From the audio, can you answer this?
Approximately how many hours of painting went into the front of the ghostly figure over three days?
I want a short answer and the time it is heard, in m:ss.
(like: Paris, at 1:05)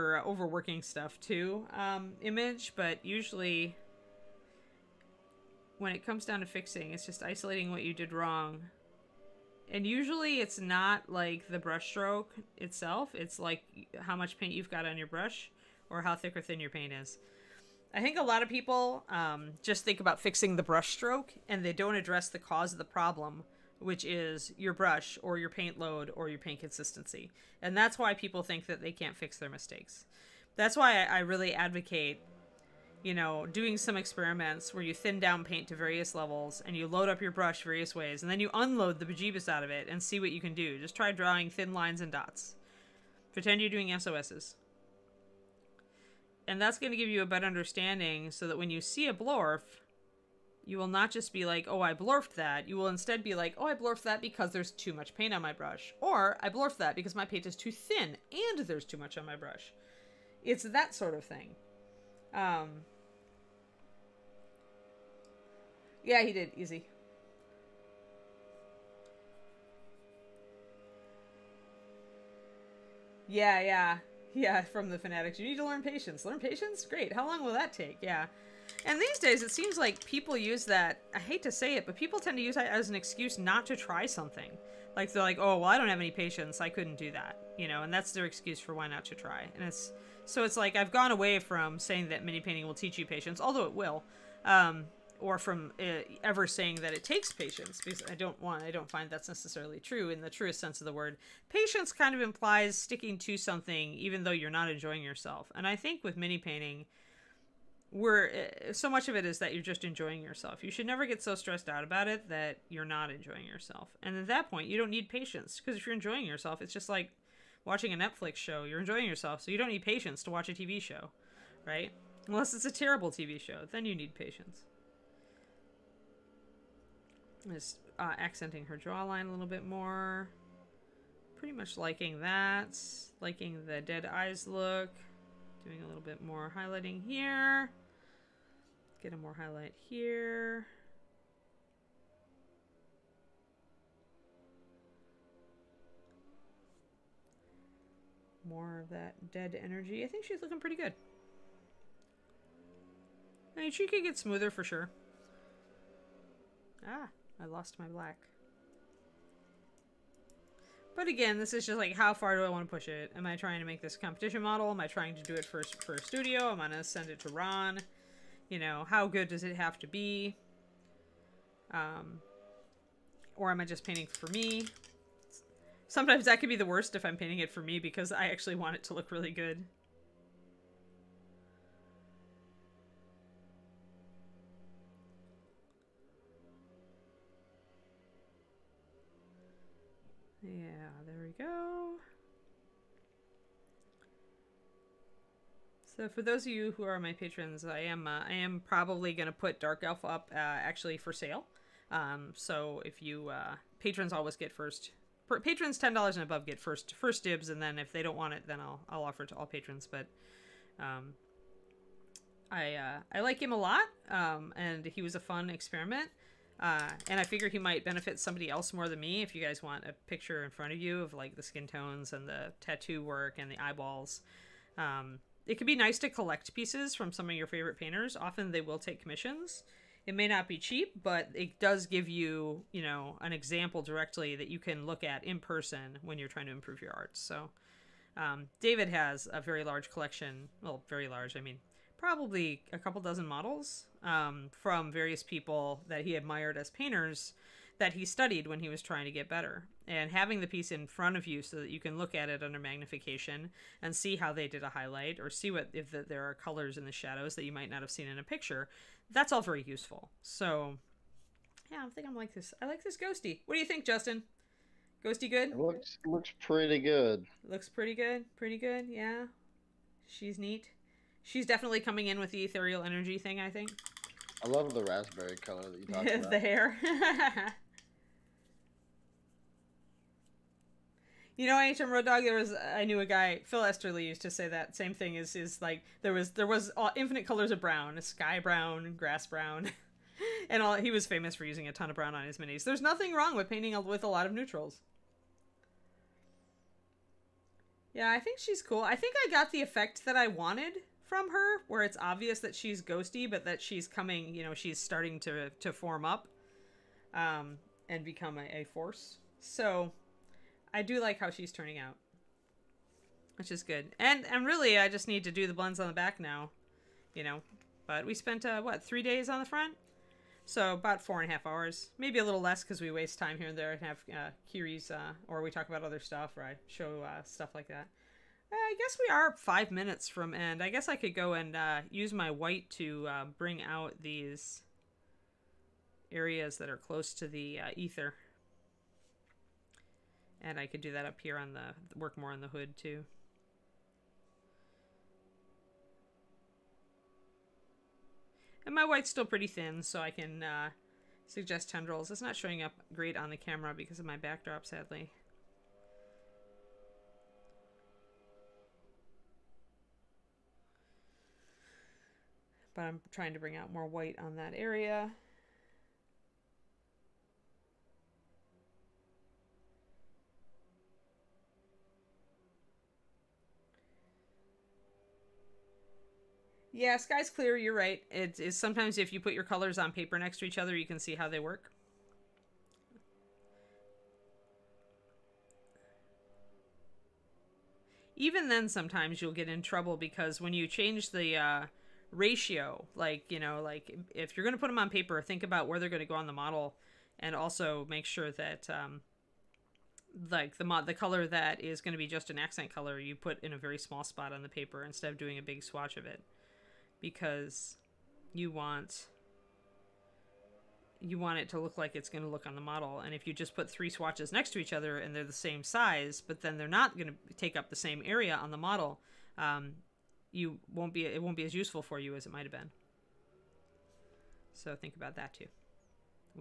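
4.5 hours, at 5:21.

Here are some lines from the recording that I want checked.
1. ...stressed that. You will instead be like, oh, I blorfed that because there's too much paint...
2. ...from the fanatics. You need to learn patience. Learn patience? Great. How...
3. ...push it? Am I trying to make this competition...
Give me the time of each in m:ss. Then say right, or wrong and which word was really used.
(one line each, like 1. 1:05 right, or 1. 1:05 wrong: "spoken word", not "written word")
1. 0:51 wrong: "blorfed", not "stressed"
2. 1:14 right
3. 2:42 right.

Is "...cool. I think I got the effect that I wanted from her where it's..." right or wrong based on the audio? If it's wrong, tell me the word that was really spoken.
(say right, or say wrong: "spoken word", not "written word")
right.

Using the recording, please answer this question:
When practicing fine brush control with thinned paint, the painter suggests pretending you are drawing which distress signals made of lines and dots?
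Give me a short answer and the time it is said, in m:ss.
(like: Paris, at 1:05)
SOSs, at 0:43.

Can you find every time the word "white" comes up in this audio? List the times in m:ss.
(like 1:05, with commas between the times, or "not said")
5:32, 5:48, 6:03.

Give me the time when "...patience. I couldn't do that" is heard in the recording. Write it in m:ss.
1:26.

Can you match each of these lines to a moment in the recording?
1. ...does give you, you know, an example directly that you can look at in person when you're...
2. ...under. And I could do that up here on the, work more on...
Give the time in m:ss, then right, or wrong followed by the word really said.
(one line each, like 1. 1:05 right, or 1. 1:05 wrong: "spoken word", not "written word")
1. 3:51 right
2. 5:37 wrong: "ether", not "under".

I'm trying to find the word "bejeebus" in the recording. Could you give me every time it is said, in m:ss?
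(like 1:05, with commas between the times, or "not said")
0:39.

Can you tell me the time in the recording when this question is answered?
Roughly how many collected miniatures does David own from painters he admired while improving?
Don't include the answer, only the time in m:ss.
4:02.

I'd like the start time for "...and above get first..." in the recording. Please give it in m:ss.
3:26.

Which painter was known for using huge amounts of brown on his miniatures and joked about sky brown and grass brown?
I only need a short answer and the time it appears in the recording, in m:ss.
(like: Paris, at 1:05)
Phil Esterly, at 4:43.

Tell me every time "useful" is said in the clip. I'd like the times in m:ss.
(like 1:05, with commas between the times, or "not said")
4:19, 7:01.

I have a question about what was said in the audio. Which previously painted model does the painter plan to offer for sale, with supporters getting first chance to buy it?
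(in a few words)
Dark Elf.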